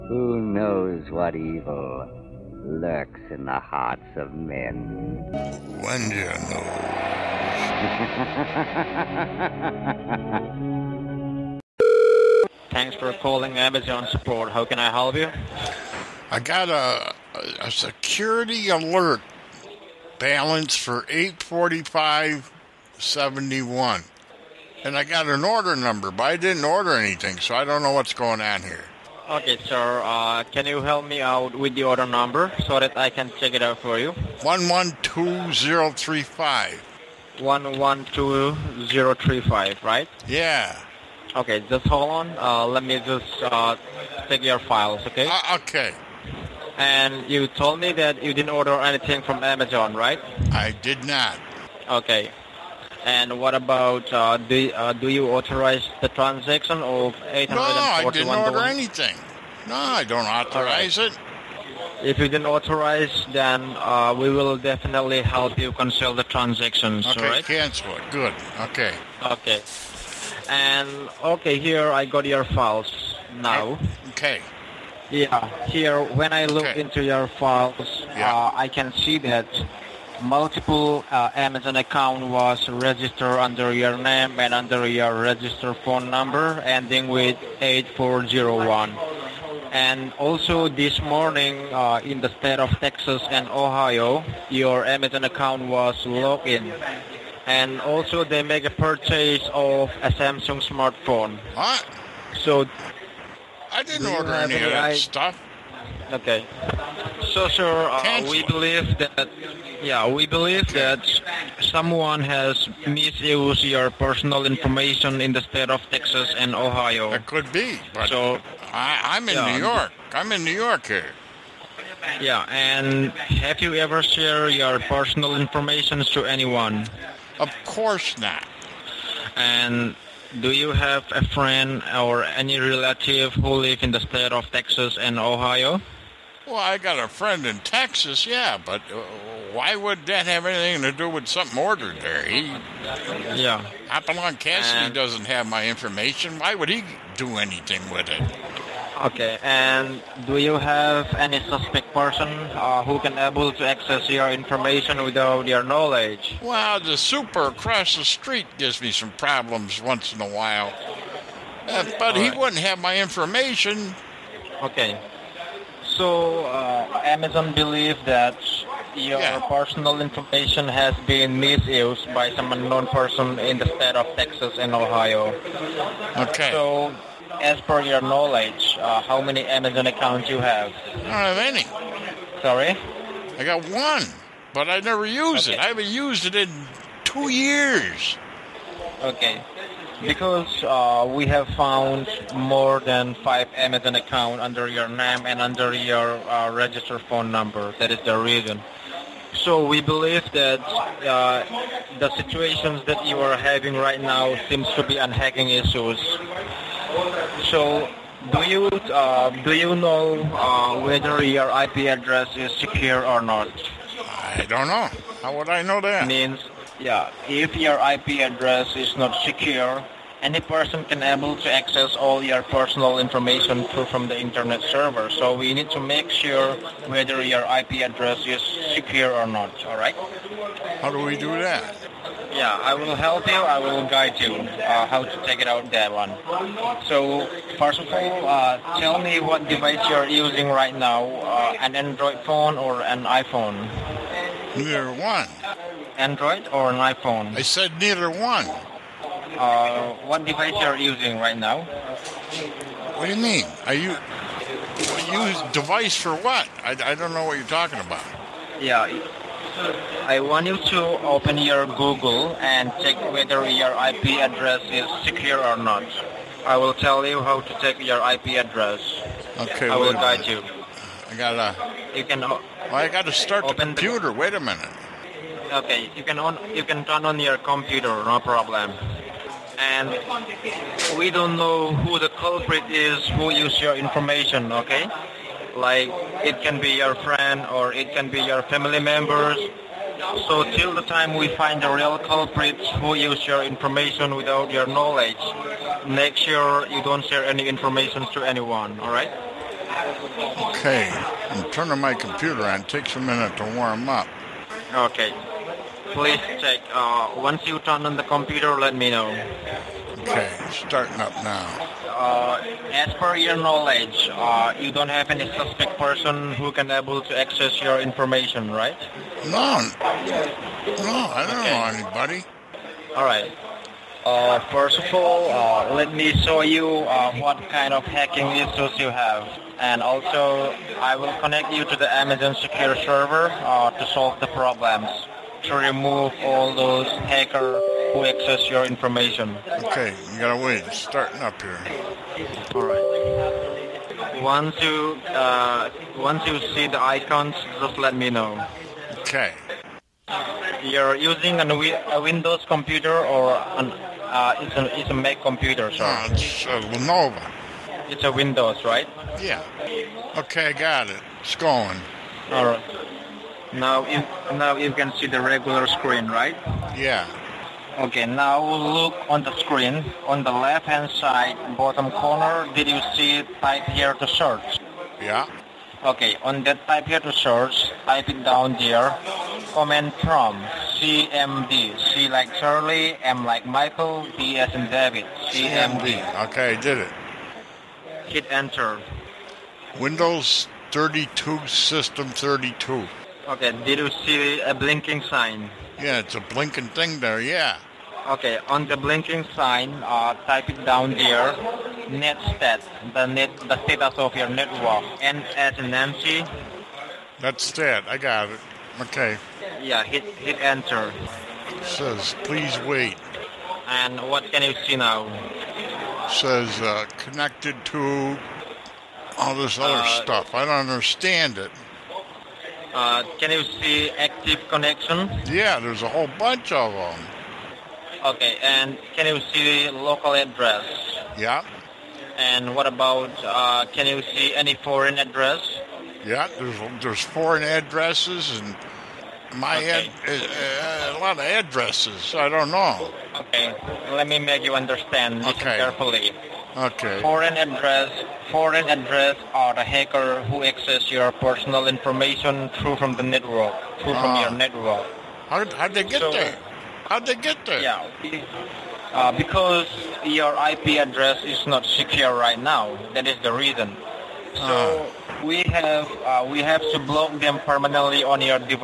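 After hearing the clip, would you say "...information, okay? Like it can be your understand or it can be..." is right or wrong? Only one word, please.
wrong.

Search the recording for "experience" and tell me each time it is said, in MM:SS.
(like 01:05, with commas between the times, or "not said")
not said.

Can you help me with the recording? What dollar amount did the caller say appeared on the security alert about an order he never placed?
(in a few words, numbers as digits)
845.71.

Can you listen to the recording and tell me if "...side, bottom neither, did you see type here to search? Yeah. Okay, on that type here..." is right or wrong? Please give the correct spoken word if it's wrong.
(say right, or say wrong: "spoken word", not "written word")
wrong: "corner", not "neither".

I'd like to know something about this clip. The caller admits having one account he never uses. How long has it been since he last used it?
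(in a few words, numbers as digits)
2 years.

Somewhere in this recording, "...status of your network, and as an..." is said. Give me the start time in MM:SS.
06:43.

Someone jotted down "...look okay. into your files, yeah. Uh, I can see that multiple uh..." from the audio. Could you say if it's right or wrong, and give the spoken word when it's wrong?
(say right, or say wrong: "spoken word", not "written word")
right.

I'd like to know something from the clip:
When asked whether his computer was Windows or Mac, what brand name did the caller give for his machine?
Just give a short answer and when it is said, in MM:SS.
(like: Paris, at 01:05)
Lenovo, at 05:56.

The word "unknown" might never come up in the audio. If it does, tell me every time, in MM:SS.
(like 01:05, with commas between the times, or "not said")
02:52.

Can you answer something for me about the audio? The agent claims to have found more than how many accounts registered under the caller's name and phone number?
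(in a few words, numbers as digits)
5.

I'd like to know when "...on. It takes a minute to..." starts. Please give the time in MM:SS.
05:02.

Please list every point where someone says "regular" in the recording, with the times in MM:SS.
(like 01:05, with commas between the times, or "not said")
06:05.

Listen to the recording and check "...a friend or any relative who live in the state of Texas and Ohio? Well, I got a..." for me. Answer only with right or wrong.
right.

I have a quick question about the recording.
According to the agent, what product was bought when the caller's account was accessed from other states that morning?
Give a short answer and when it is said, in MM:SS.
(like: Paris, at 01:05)
Samsung smartphone, at 01:40.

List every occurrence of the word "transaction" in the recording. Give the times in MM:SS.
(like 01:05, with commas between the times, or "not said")
00:56, 01:06.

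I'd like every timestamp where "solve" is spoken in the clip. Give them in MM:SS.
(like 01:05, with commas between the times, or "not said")
05:33.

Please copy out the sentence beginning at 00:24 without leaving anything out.
And I got an order number, but I didn't order anything, so I don't know what's going on here.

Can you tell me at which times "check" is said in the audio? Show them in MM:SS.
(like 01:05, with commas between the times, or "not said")
00:33, 04:22, 04:27, 05:06.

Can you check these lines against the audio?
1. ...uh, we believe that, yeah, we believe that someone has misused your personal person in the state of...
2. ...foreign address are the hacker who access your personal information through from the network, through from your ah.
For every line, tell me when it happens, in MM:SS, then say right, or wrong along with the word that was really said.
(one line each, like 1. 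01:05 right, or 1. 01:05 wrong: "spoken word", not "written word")
1. 01:47 wrong: "information", not "person"
2. 07:28 right.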